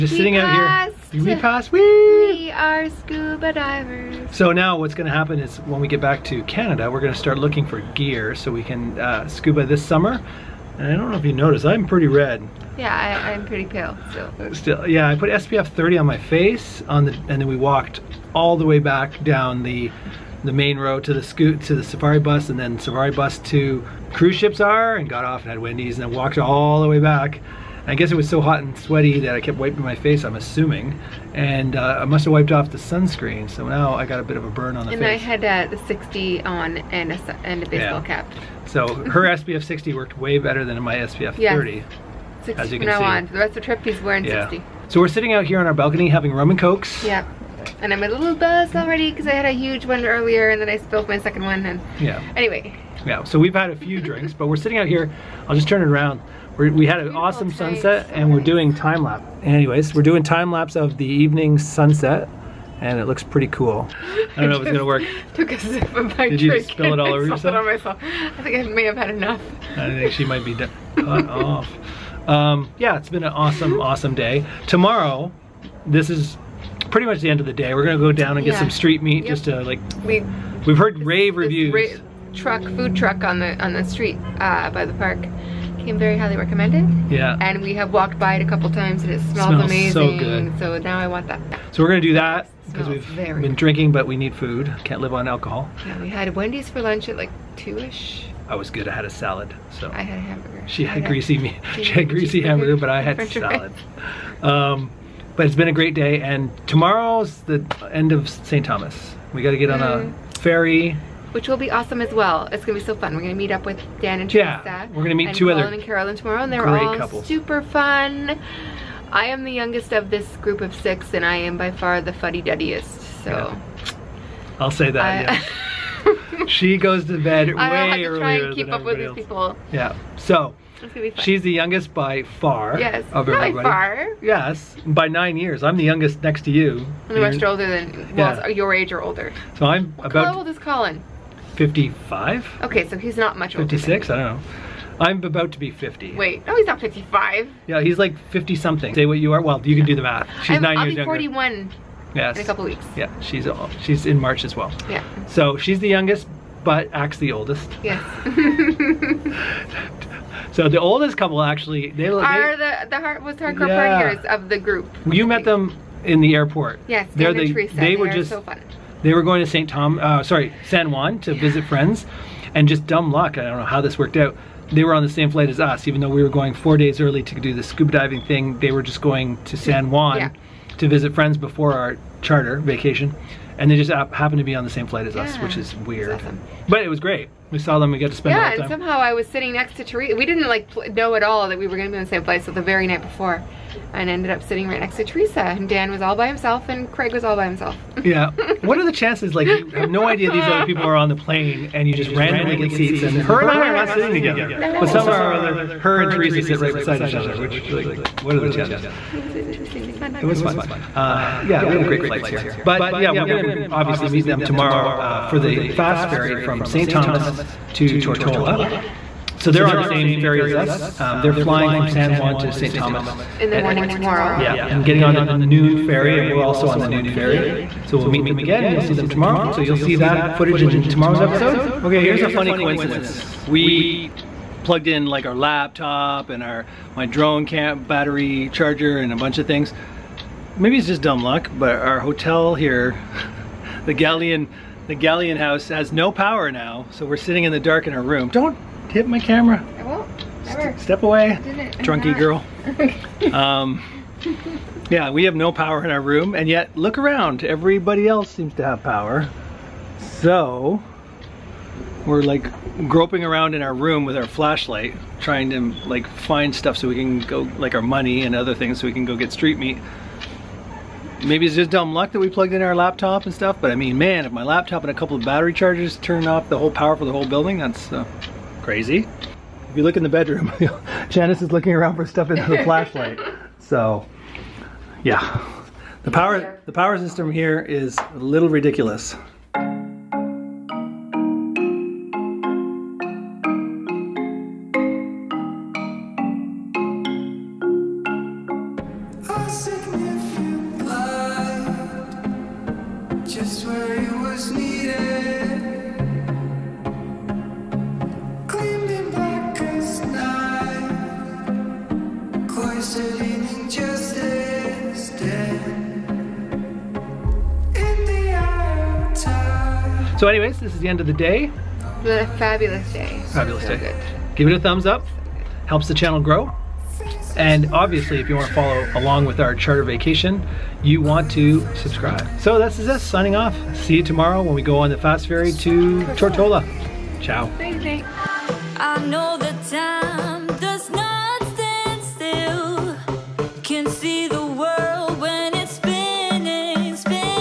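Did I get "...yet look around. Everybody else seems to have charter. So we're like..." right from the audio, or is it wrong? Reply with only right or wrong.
wrong.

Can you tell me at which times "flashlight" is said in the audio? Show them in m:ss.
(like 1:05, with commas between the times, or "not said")
4:24, 4:42.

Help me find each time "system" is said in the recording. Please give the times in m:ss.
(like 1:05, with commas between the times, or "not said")
4:46.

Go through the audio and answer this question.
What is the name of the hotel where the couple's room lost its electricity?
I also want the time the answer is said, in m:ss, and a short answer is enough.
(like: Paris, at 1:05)
Galleon House, at 4:04.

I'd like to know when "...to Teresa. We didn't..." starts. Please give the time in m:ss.
3:09.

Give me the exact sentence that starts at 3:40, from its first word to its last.
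Um, they're flying from San Juan to St.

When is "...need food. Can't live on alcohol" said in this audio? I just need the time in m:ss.
1:34.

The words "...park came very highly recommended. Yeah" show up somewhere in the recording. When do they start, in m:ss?
1:24.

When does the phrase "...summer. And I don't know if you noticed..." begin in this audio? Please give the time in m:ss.
0:09.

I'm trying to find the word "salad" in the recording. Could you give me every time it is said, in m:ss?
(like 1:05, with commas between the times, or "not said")
1:39, 1:43.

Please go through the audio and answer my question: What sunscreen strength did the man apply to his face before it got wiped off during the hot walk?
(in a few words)
SPF 30.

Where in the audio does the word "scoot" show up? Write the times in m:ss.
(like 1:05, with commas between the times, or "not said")
0:21.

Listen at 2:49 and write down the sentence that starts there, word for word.
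Tom, uh, sorry, San Juan to yeah.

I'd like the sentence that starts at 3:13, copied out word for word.
And ended up sitting right next to Teresa and Dan was all by himself and Craig was all by himself.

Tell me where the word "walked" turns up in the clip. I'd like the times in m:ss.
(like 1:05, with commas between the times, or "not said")
0:17, 0:26, 1:27.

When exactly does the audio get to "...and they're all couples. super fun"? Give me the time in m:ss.
1:56.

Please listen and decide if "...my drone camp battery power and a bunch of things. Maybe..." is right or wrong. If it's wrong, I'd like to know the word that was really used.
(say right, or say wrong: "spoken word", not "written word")
wrong: "charger", not "power".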